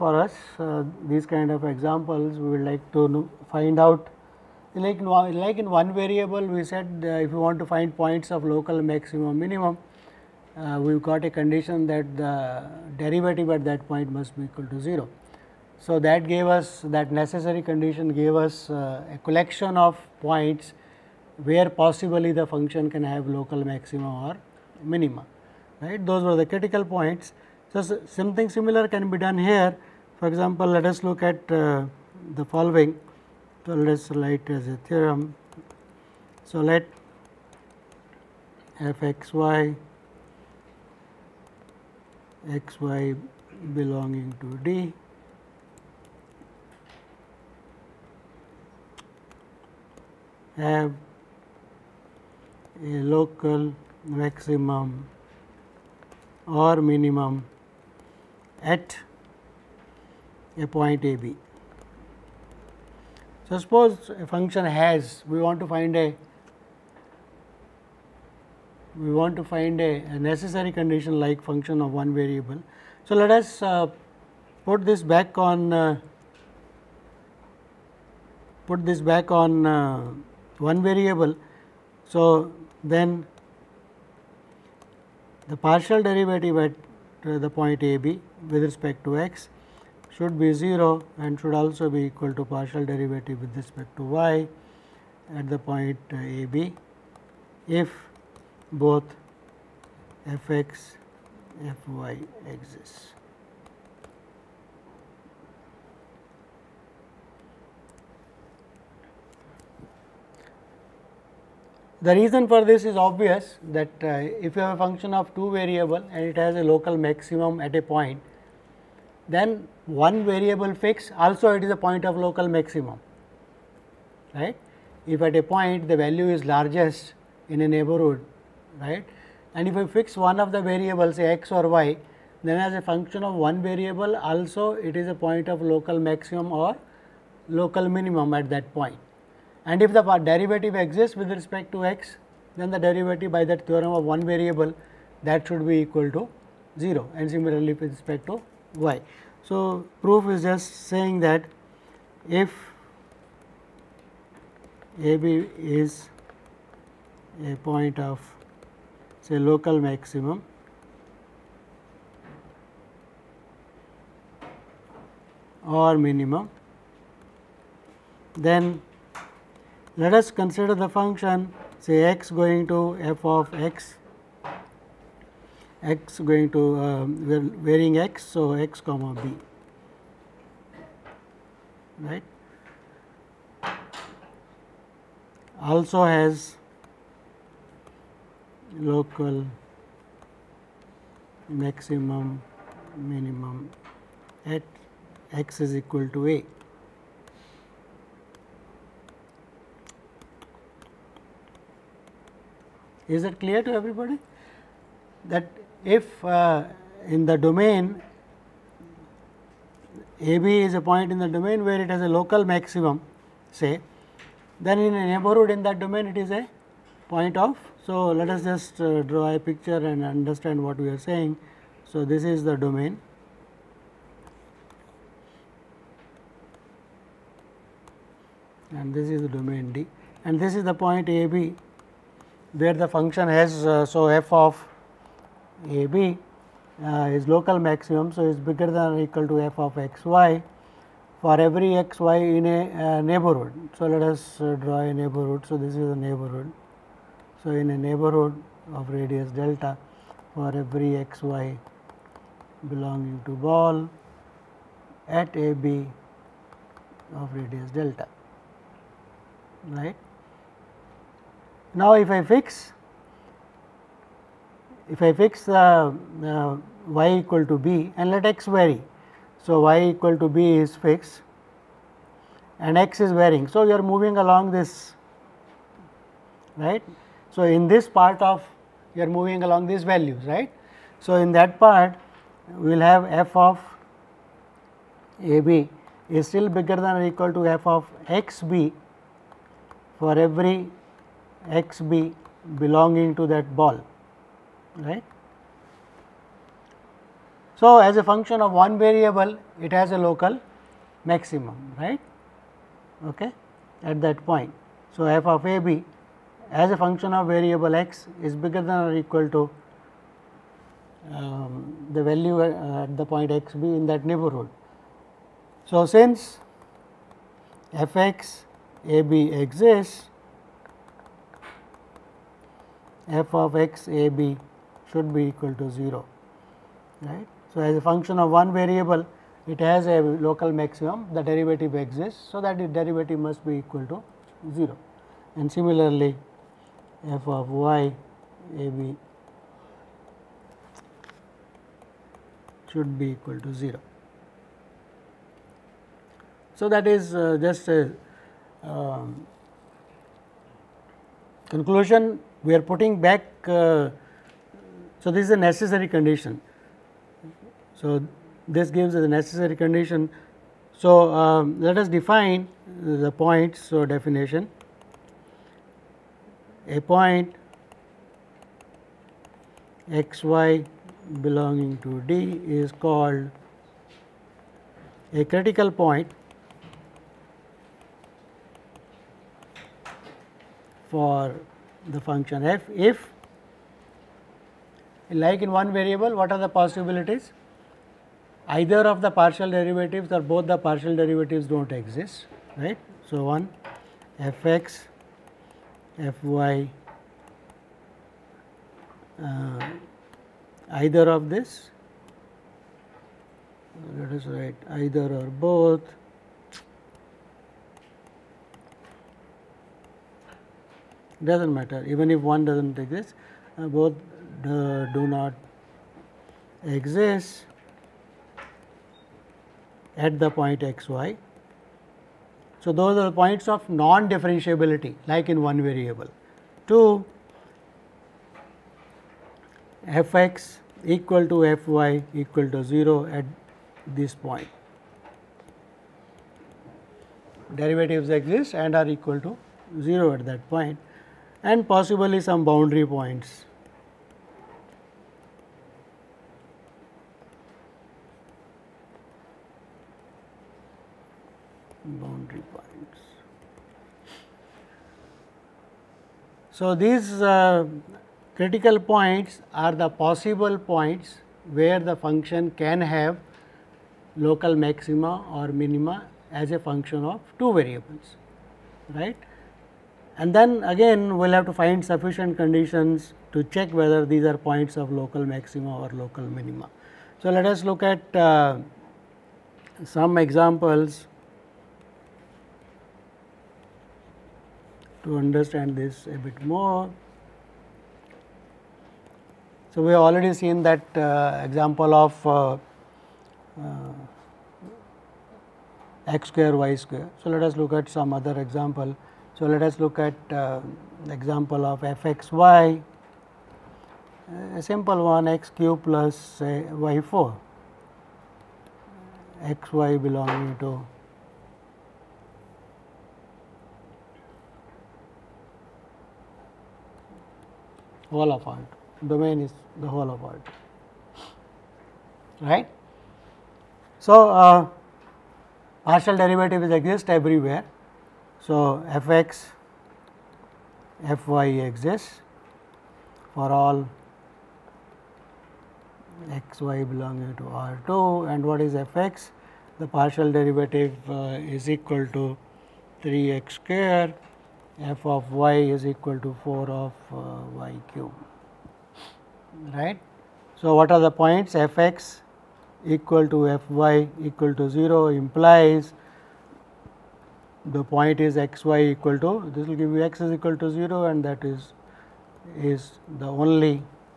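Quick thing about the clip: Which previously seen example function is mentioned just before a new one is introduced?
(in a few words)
x square y square.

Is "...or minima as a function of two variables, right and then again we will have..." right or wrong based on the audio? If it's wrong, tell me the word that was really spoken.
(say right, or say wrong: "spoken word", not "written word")
right.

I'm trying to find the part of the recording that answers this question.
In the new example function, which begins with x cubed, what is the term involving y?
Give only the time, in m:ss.
8:26.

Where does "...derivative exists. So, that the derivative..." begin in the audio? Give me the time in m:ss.
5:31.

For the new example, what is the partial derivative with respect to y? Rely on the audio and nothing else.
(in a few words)
4y cubed.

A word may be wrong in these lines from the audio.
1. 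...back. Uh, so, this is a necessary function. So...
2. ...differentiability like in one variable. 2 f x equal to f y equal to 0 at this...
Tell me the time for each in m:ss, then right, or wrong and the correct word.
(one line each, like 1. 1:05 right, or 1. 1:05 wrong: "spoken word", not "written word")
1. 5:52 wrong: "condition", not "function"
2. 7:04 right.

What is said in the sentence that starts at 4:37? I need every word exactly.
So, in this part of you are moving along these values right.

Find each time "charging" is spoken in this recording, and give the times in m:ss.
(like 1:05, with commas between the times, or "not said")
not said.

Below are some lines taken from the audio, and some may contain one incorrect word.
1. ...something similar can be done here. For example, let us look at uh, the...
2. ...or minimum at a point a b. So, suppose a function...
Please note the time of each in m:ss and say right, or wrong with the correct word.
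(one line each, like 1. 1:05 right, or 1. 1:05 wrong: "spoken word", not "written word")
1. 0:28 right
2. 0:56 right.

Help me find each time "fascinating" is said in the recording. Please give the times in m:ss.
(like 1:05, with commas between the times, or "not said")
not said.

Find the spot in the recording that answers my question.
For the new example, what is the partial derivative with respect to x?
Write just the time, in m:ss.
9:03.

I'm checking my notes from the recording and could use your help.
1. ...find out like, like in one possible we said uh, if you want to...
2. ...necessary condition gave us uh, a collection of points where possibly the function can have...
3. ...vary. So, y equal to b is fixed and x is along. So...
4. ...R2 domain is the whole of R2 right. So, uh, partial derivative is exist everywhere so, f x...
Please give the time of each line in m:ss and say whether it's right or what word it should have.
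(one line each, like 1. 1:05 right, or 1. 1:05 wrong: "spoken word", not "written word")
1. 0:03 wrong: "variable", not "possible"
2. 0:17 right
3. 4:28 wrong: "varying", not "along"
4. 8:38 right.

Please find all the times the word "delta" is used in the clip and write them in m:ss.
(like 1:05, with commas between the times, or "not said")
4:09, 4:17.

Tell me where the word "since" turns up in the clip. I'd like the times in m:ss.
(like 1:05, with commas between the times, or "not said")
5:15.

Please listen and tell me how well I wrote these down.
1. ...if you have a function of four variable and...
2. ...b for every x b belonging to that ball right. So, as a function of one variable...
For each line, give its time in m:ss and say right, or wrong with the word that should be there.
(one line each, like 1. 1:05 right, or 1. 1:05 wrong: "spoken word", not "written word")
1. 1:54 wrong: "two", not "four"
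2. 4:48 right.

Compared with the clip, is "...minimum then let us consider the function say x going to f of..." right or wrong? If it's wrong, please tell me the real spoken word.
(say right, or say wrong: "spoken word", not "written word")
right.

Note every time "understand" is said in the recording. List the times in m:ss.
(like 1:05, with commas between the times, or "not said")
3:40, 8:05.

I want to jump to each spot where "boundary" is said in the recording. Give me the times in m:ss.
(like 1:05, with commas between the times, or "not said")
7:22, 7:32.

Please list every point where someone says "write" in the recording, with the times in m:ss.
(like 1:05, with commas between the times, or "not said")
0:34, 6:44.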